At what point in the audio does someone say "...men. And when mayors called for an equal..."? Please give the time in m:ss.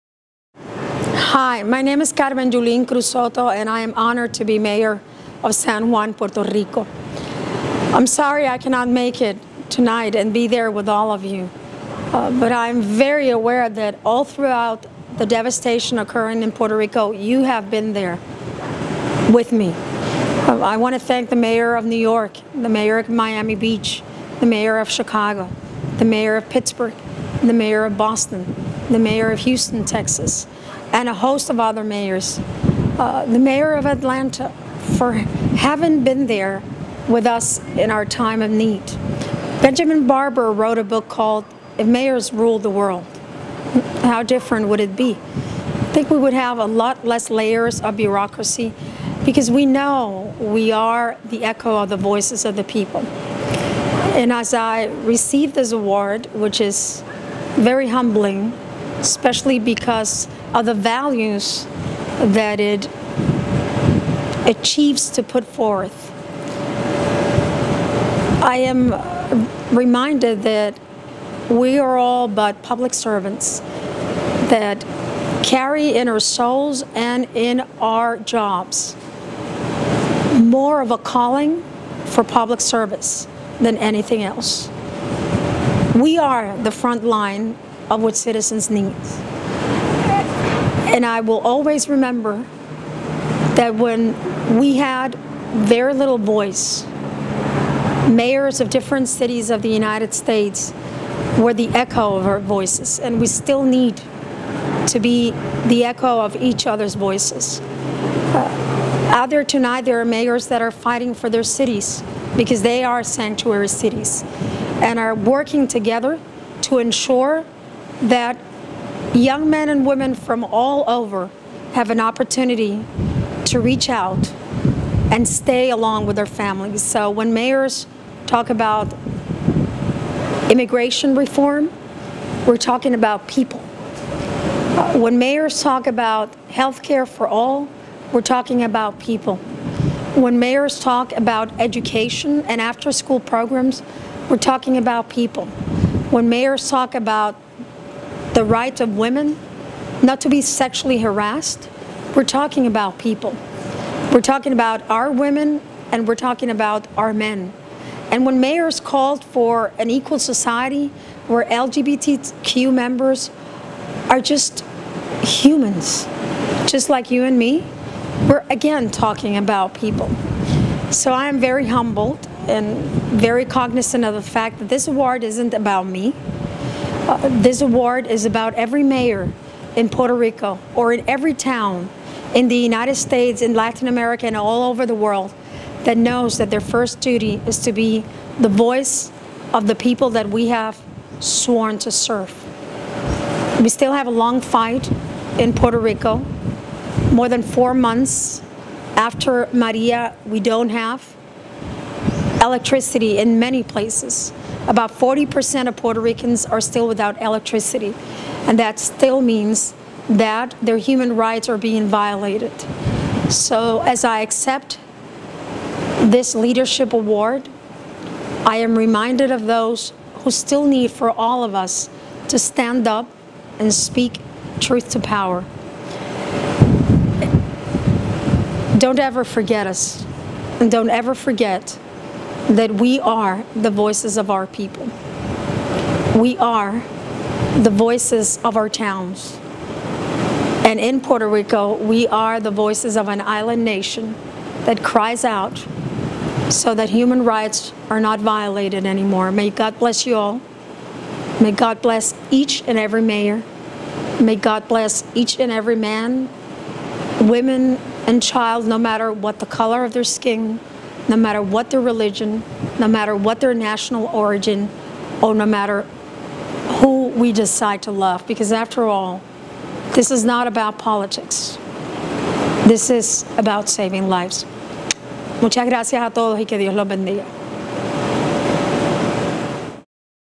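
2:37.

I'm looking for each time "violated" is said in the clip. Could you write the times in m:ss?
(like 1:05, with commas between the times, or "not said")
3:31, 4:08.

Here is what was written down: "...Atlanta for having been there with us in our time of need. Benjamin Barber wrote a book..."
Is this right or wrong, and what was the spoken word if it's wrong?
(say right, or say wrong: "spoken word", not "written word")
right.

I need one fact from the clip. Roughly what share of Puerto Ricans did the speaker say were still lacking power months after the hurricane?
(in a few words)
40%.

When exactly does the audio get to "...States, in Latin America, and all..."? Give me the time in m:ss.
3:02.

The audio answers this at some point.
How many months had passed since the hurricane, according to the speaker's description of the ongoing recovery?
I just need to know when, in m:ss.
3:17.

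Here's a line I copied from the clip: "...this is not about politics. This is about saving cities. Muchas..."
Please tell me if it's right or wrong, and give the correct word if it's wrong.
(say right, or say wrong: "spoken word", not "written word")
wrong: "lives", not "cities".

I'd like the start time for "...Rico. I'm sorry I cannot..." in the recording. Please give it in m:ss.
0:06.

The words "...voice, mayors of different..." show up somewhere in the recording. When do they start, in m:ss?
1:36.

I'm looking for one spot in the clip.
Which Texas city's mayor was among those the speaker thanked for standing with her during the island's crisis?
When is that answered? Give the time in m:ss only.
0:29.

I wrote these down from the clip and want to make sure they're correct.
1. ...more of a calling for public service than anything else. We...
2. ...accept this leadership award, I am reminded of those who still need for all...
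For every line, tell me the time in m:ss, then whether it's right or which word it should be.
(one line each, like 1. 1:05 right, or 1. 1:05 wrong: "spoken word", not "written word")
1. 1:20 right
2. 3:34 right.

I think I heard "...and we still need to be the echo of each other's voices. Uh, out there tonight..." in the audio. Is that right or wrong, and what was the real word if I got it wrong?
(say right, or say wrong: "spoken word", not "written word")
right.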